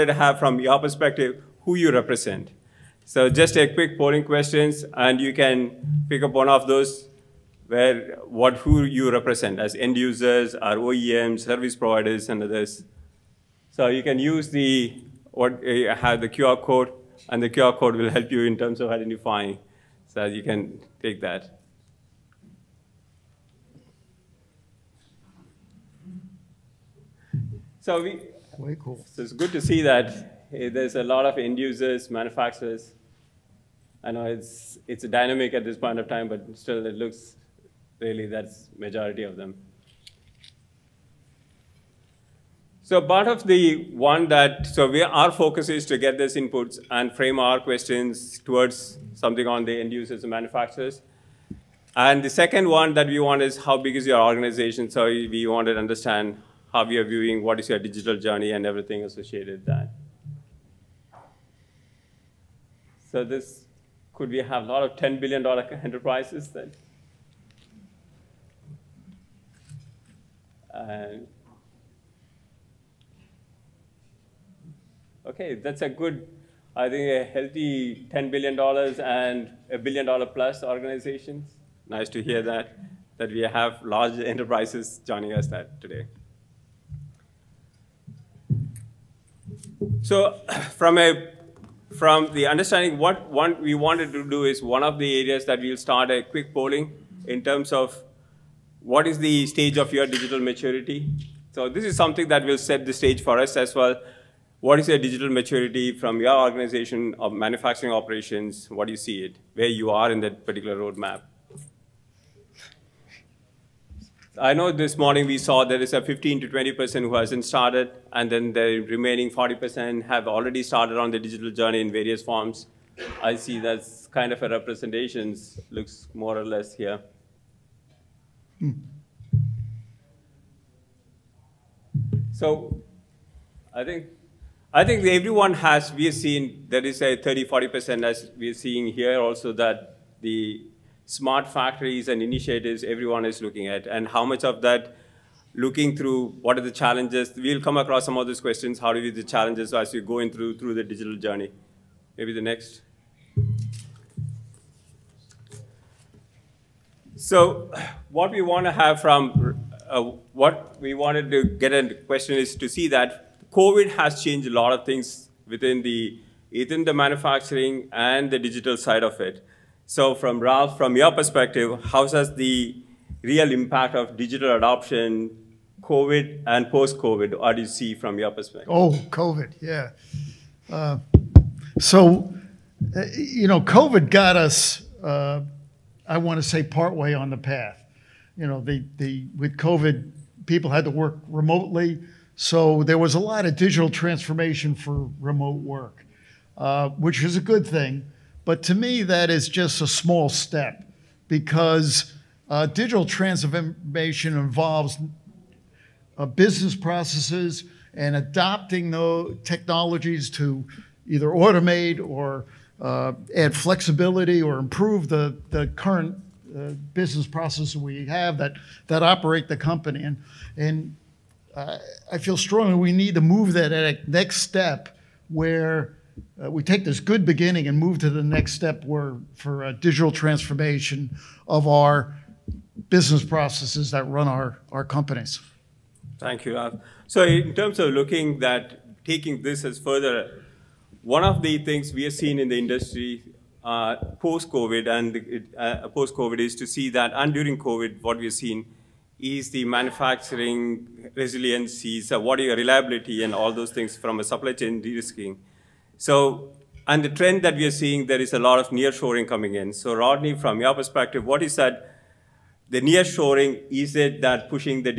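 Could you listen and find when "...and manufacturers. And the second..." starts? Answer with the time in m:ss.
0:50.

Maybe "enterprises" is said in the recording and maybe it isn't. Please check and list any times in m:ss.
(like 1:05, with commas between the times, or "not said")
1:05, 1:24.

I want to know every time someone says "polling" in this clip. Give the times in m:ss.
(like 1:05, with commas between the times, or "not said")
0:03, 1:36.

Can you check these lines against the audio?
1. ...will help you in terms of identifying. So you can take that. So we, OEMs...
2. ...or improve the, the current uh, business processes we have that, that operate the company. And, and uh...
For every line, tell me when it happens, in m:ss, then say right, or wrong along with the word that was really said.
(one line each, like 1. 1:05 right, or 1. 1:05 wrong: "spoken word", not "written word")
1. 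0:17 wrong: "Way", not "OEMs"
2. 3:34 right.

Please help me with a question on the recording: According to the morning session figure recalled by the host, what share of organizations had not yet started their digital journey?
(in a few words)
15 to 20%.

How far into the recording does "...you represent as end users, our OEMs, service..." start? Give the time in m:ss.
0:08.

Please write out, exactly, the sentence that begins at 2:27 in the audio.
We'll come across some of those questions.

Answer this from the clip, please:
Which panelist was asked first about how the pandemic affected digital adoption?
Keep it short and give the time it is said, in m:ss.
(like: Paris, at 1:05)
Ralph, at 2:50.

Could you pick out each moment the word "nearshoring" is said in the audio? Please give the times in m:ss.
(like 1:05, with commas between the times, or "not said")
4:18, 4:22.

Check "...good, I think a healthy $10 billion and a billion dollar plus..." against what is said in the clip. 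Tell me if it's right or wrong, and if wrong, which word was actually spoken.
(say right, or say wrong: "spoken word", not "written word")
right.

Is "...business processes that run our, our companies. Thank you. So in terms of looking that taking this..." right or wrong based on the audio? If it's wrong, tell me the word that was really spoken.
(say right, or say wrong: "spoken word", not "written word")
right.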